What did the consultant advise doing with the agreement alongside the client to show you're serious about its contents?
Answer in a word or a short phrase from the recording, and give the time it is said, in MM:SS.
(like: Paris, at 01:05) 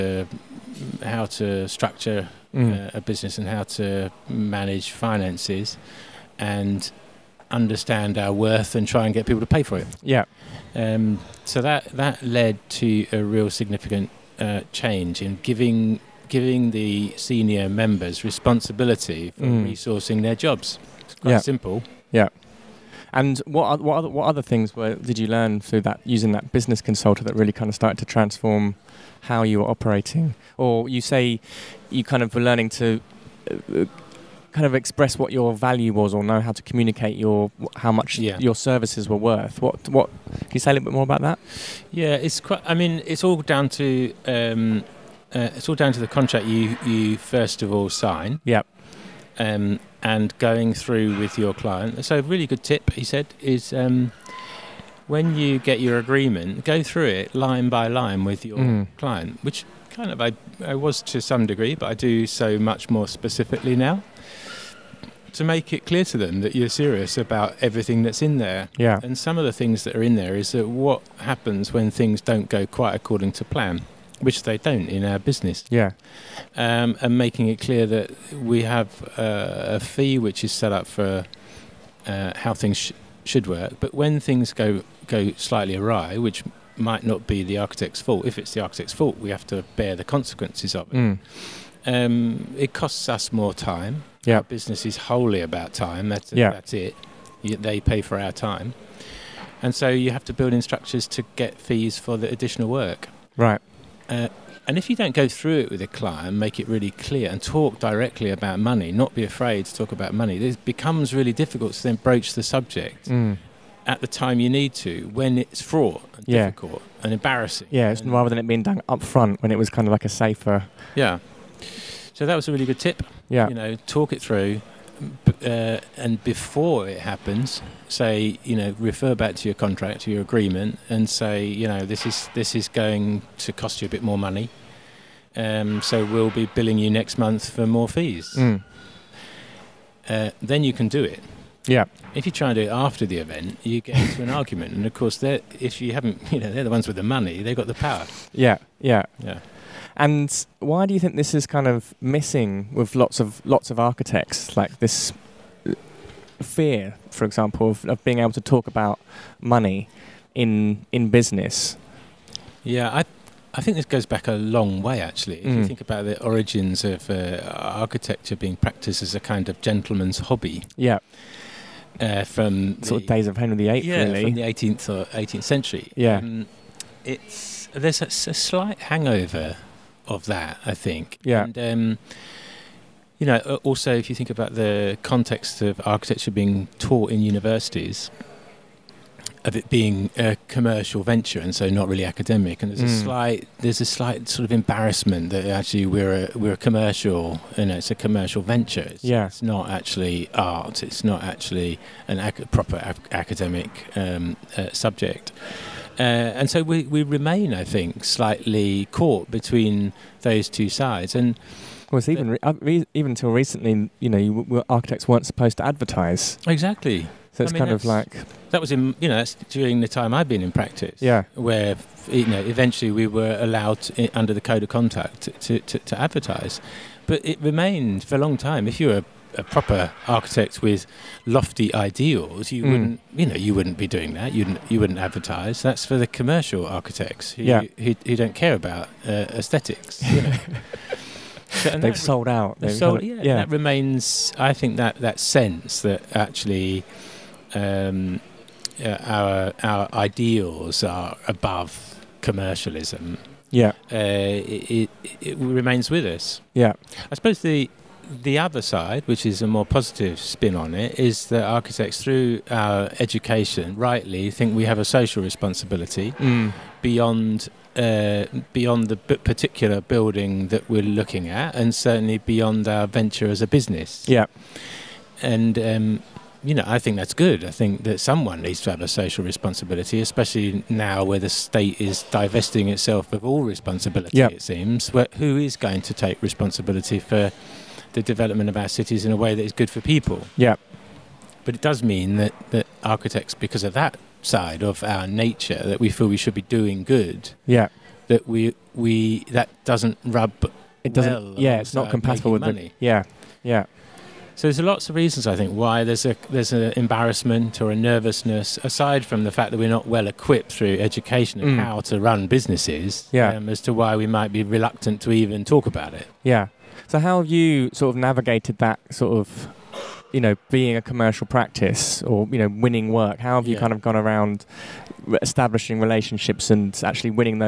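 Go through it line by line, at 00:57.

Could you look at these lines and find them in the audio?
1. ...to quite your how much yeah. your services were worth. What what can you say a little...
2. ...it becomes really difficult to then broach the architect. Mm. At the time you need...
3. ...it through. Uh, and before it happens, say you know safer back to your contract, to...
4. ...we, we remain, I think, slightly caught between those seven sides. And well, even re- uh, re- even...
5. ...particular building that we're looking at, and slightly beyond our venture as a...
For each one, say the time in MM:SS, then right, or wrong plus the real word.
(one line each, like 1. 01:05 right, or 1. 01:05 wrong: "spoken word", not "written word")
1. 00:36 wrong: "communicate", not "quite"
2. 01:50 wrong: "subject", not "architect"
3. 02:04 wrong: "refer", not "safer"
4. 03:26 wrong: "two", not "seven"
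5. 04:28 wrong: "certainly", not "slightly".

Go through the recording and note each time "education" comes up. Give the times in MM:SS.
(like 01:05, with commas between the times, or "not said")
04:22, 05:10.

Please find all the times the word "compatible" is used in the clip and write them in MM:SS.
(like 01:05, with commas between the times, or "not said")
05:01.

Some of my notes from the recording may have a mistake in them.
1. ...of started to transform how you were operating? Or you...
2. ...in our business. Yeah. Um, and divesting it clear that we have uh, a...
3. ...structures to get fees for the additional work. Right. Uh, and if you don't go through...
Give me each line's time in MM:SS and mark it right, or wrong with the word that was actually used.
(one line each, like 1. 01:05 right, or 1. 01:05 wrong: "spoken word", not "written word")
1. 00:27 right
2. 01:14 wrong: "making", not "divesting"
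3. 01:40 right.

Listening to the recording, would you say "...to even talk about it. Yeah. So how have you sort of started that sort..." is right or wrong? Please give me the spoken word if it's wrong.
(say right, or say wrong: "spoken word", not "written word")
wrong: "navigated", not "started".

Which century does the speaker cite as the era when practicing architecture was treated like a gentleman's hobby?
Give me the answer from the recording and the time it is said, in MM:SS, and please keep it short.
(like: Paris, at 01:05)
18th century, at 02:55.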